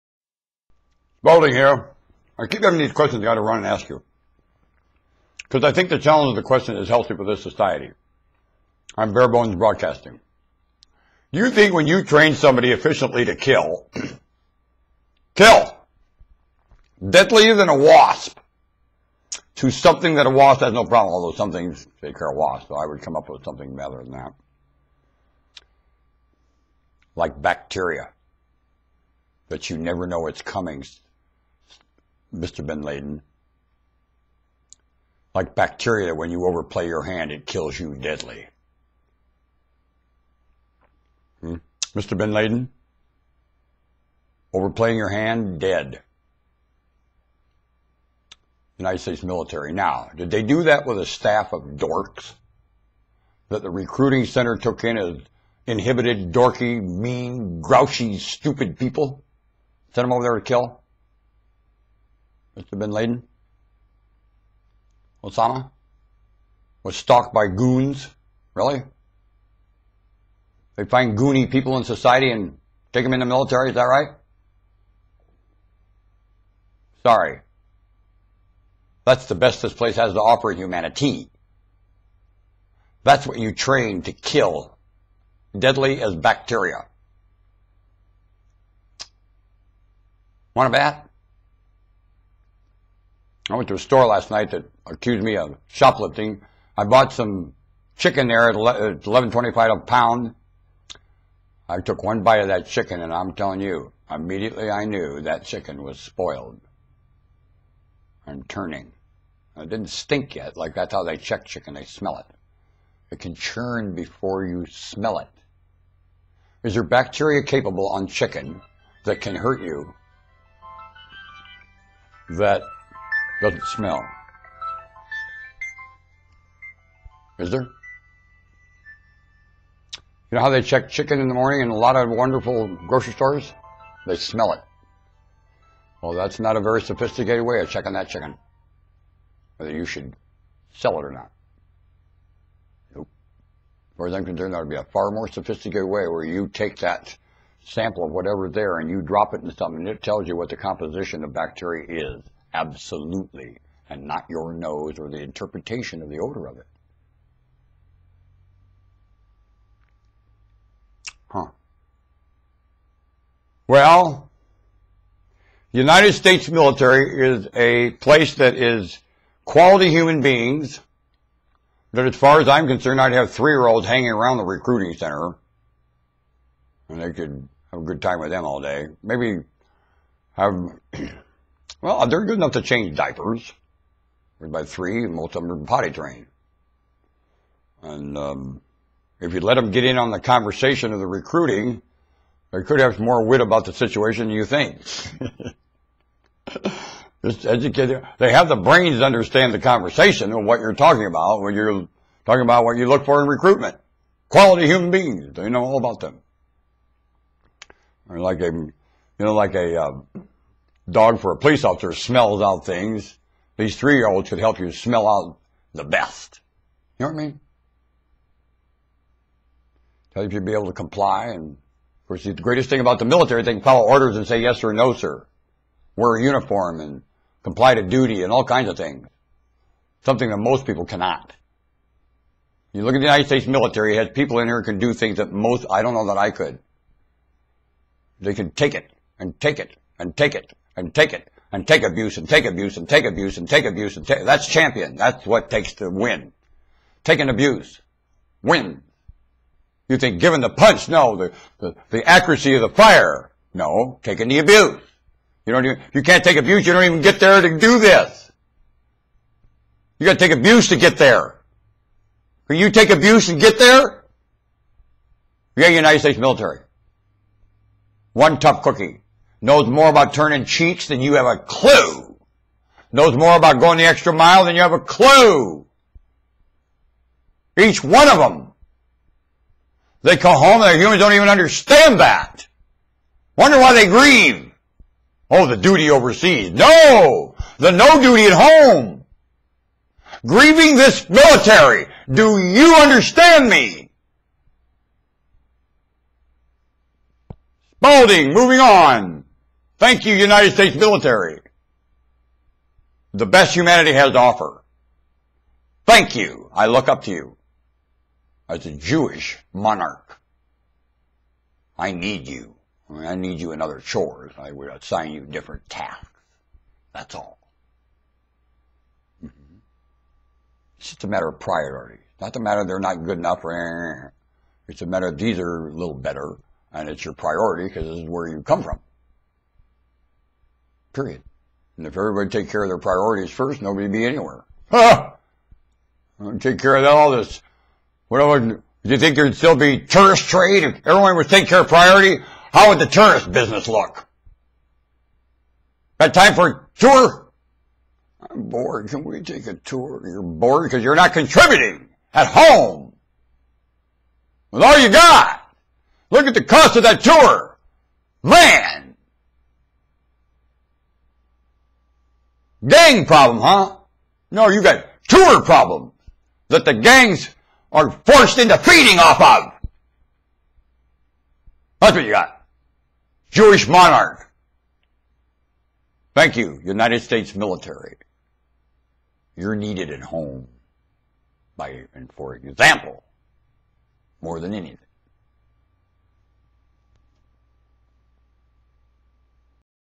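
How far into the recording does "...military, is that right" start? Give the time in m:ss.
1:13.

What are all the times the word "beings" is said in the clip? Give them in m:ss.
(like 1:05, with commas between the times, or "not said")
2:50, 3:24.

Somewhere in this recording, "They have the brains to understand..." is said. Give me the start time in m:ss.
3:18.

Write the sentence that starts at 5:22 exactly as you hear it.
Not a matter they're not good enough or eh, eh, eh.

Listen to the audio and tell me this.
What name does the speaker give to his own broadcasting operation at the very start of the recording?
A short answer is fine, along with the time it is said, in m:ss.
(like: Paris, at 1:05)
Bare Bones Broadcasting, at 0:09.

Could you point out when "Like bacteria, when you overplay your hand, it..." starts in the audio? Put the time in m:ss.
0:35.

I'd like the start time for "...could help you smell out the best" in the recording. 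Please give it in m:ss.
3:34.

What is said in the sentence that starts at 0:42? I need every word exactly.
Bin Laden, overplaying your hand, dead.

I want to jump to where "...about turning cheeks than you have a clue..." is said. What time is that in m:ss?
4:29.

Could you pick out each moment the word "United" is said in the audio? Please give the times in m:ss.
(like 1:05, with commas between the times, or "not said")
0:48, 2:45, 3:53, 4:25, 5:00, 6:16.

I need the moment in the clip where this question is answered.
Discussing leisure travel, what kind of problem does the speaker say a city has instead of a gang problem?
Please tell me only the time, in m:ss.
6:05.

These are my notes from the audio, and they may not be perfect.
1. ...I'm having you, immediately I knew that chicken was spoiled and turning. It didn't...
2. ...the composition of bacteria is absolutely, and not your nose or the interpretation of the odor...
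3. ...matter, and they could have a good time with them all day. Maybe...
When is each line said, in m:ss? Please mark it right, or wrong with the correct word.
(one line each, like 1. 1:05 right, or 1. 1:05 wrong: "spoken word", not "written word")
1. 1:43 wrong: "telling", not "having"
2. 2:30 right
3. 2:54 wrong: "center", not "matter".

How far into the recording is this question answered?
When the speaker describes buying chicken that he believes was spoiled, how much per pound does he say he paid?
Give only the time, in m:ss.
1:38.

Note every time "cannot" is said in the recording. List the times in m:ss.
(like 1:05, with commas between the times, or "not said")
3:50.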